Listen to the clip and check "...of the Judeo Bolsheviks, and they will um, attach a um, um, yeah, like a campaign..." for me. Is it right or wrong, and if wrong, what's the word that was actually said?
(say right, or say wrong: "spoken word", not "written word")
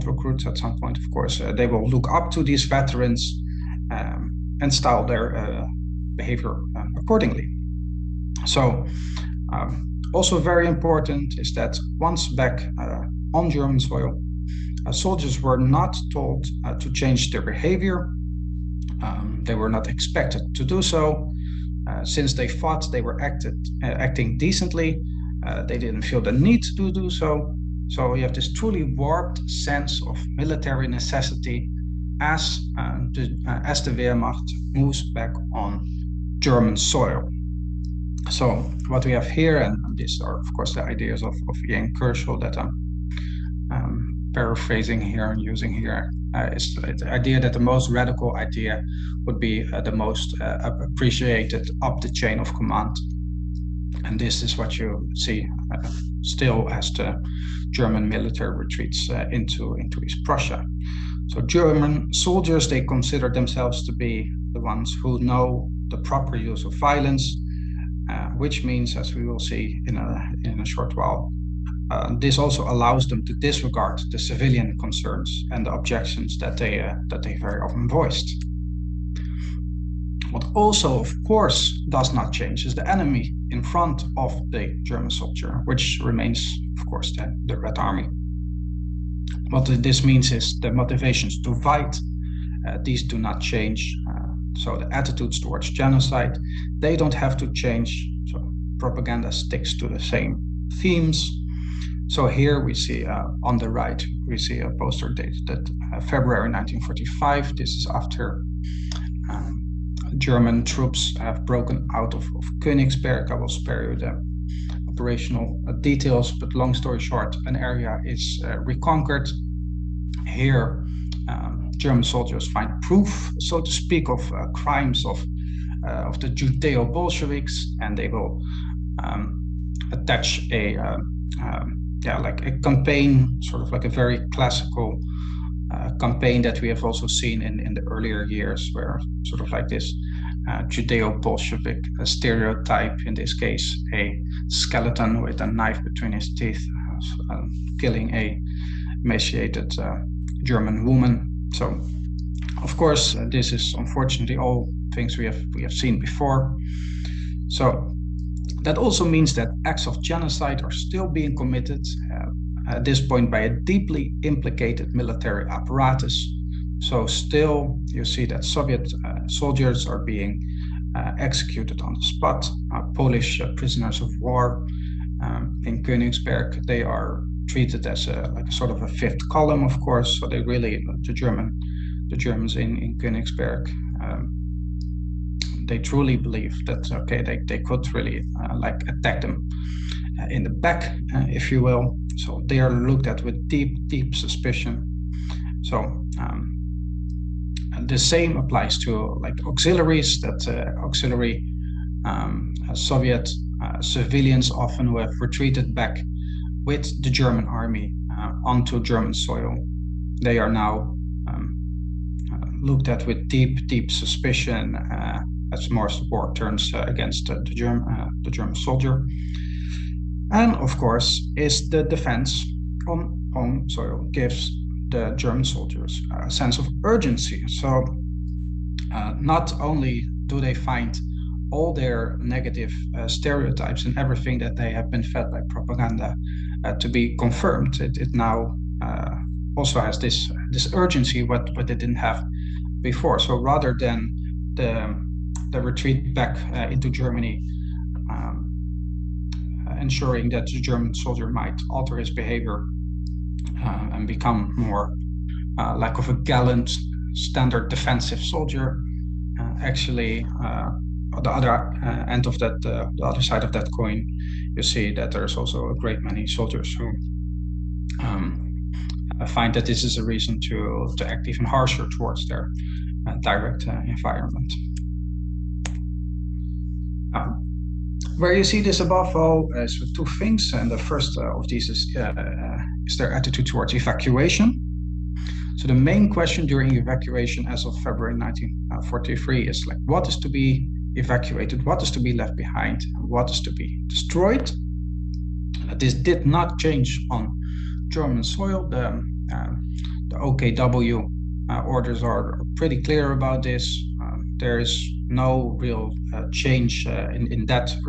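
right.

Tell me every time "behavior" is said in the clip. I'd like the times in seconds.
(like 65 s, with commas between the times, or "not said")
6 s, 17 s, 252 s.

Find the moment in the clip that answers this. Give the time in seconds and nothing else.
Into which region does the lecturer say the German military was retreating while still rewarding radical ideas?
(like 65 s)
60 s.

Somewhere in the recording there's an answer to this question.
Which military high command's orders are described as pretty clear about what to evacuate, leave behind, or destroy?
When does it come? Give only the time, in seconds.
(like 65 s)
300 s.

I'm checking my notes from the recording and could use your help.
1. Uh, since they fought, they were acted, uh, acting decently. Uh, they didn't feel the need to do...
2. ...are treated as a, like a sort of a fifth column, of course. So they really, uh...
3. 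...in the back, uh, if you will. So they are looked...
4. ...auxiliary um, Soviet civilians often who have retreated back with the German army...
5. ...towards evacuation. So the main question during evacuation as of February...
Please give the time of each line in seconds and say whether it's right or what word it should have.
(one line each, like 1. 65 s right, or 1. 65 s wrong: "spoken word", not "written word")
1. 21 s right
2. 176 s right
3. 190 s right
4. 200 s right
5. 283 s right.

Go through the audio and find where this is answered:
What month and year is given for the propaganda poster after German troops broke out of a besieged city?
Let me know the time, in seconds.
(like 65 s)
106 s.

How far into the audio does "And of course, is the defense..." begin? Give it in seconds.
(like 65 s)
220 s.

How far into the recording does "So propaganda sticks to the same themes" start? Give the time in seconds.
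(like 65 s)
98 s.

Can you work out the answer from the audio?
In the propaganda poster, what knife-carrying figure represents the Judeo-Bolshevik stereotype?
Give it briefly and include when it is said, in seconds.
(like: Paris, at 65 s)
a skeleton, at 143 s.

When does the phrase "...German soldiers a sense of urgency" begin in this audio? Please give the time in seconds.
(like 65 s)
225 s.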